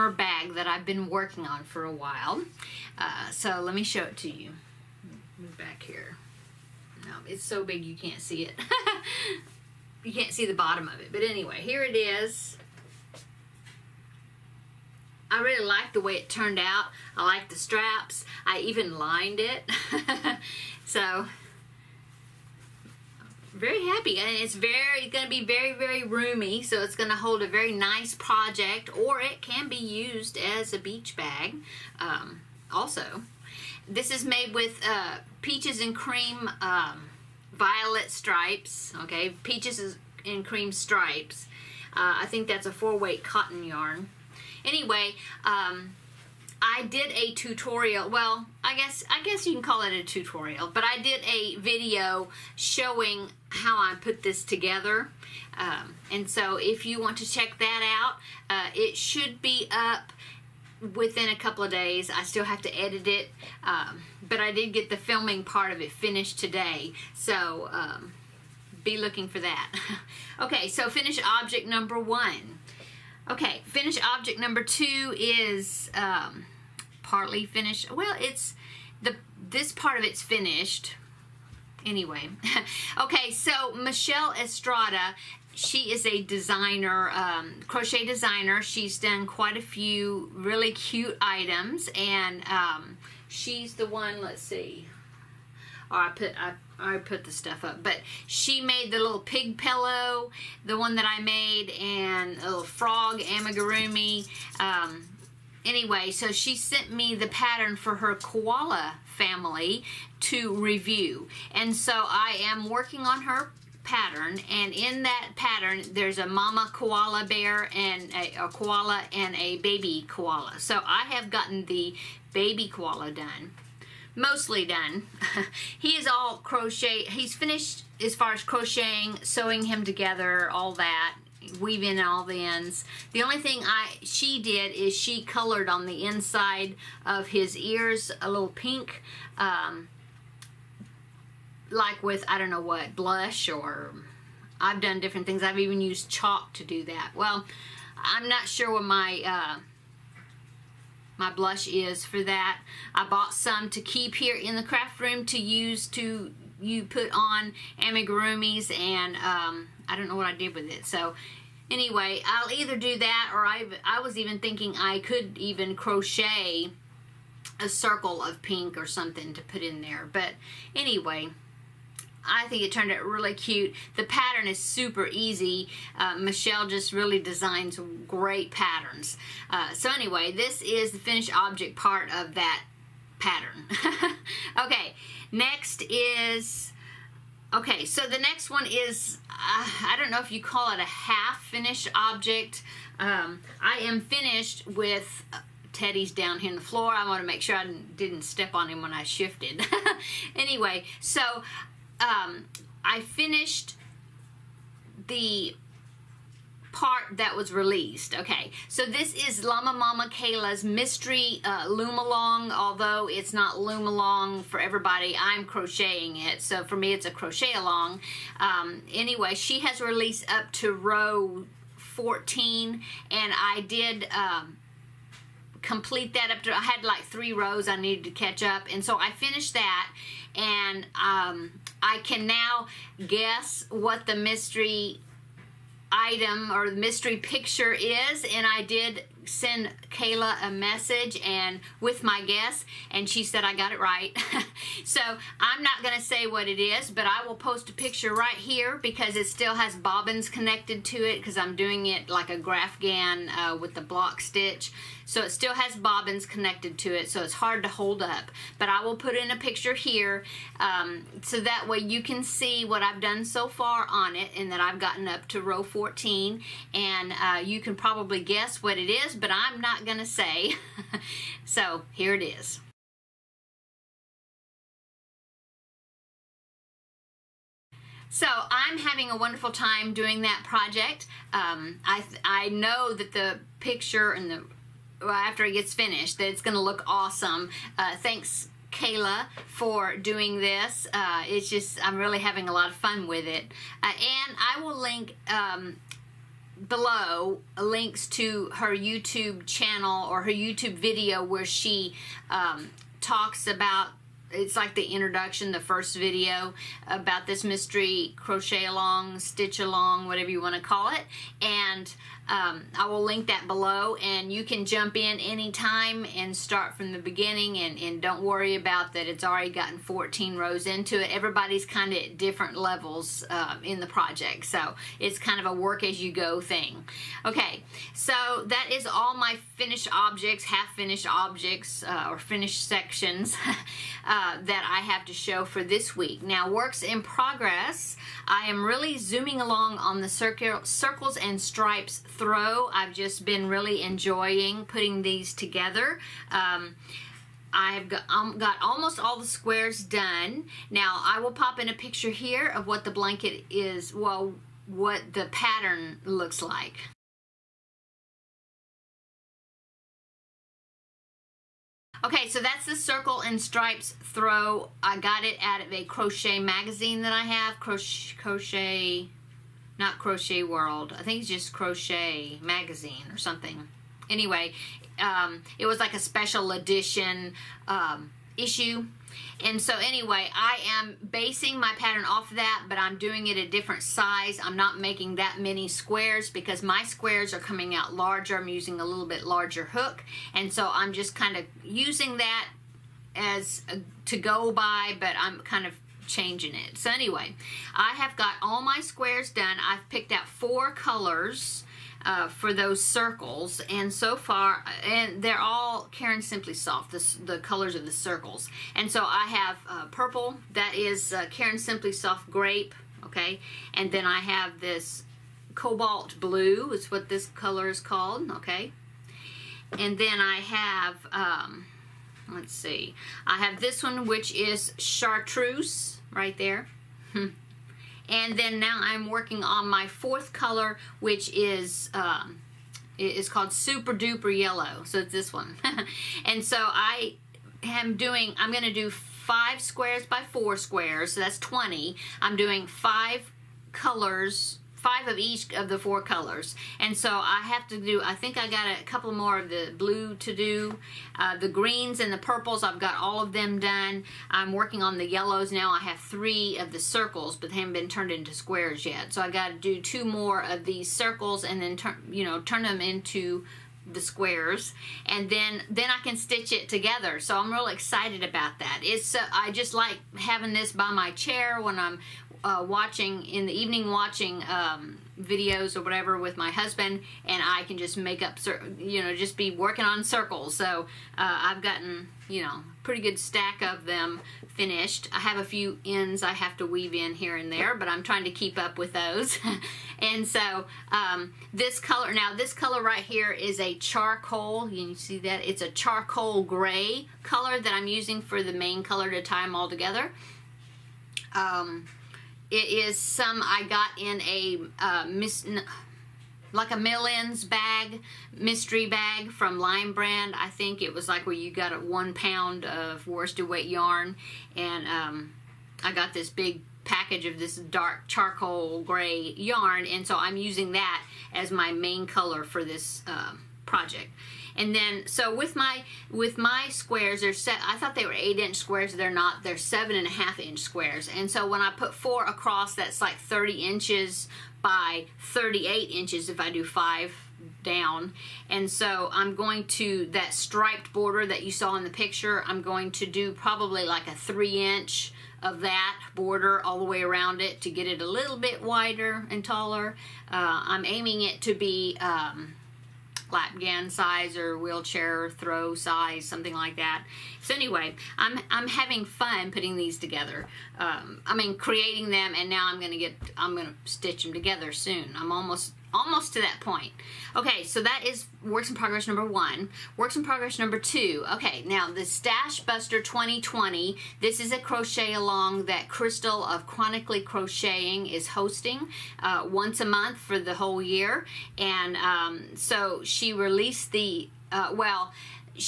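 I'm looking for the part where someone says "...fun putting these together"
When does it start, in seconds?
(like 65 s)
559 s.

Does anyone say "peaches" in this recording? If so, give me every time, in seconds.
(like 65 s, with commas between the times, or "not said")
35 s, 39 s.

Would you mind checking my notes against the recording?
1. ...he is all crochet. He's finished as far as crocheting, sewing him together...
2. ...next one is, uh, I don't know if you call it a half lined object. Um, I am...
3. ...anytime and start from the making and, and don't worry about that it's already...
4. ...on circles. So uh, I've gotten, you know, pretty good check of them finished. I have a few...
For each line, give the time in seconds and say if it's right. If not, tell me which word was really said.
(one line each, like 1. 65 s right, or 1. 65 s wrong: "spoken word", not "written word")
1. 125 s right
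2. 188 s wrong: "finished", not "lined"
3. 315 s wrong: "beginning", not "making"
4. 479 s wrong: "stack", not "check".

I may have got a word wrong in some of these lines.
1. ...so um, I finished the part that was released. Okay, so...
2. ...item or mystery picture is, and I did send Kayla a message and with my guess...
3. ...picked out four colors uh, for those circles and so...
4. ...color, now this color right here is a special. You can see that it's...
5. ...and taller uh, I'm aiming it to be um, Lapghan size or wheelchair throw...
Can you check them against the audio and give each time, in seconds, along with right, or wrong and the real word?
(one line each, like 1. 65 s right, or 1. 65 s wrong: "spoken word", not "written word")
1. 200 s right
2. 235 s right
3. 399 s right
4. 491 s wrong: "charcoal", not "special"
5. 549 s right.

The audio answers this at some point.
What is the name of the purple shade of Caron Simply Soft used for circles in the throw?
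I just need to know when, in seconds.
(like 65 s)
412 s.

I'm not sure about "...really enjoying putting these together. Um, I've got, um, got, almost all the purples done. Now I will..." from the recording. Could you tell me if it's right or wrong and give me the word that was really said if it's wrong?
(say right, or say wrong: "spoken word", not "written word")
wrong: "squares", not "purples".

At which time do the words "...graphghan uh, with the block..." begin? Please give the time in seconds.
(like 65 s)
252 s.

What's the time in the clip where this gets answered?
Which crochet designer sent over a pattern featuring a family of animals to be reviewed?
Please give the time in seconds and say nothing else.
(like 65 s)
83 s.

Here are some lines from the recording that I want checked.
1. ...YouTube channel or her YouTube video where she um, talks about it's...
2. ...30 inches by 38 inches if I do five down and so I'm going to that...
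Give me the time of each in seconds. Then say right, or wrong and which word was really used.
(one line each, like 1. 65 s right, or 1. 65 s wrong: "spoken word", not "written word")
1. 298 s right
2. 533 s right.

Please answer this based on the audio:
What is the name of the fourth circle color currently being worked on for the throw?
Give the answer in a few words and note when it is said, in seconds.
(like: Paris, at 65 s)
Super Duper Yellow, at 433 s.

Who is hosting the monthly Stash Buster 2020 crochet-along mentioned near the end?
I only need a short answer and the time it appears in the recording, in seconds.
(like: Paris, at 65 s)
Crystal, at 575 s.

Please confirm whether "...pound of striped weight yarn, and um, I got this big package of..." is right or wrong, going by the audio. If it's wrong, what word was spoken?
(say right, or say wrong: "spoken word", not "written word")
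wrong: "worsted", not "striped".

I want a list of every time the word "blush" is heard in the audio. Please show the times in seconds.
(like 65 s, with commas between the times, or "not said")
142 s, 151 s.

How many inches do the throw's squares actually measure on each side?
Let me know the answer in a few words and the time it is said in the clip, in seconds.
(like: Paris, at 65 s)
7.5, at 529 s.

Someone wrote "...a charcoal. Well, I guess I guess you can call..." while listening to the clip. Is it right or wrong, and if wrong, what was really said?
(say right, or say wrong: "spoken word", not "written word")
wrong: "tutorial", not "charcoal".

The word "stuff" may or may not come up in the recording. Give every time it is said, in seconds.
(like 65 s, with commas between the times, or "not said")
97 s.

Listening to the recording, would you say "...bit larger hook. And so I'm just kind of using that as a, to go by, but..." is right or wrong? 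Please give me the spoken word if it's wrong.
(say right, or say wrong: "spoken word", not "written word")
right.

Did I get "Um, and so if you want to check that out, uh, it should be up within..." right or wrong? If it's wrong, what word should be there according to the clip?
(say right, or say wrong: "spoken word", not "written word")
right.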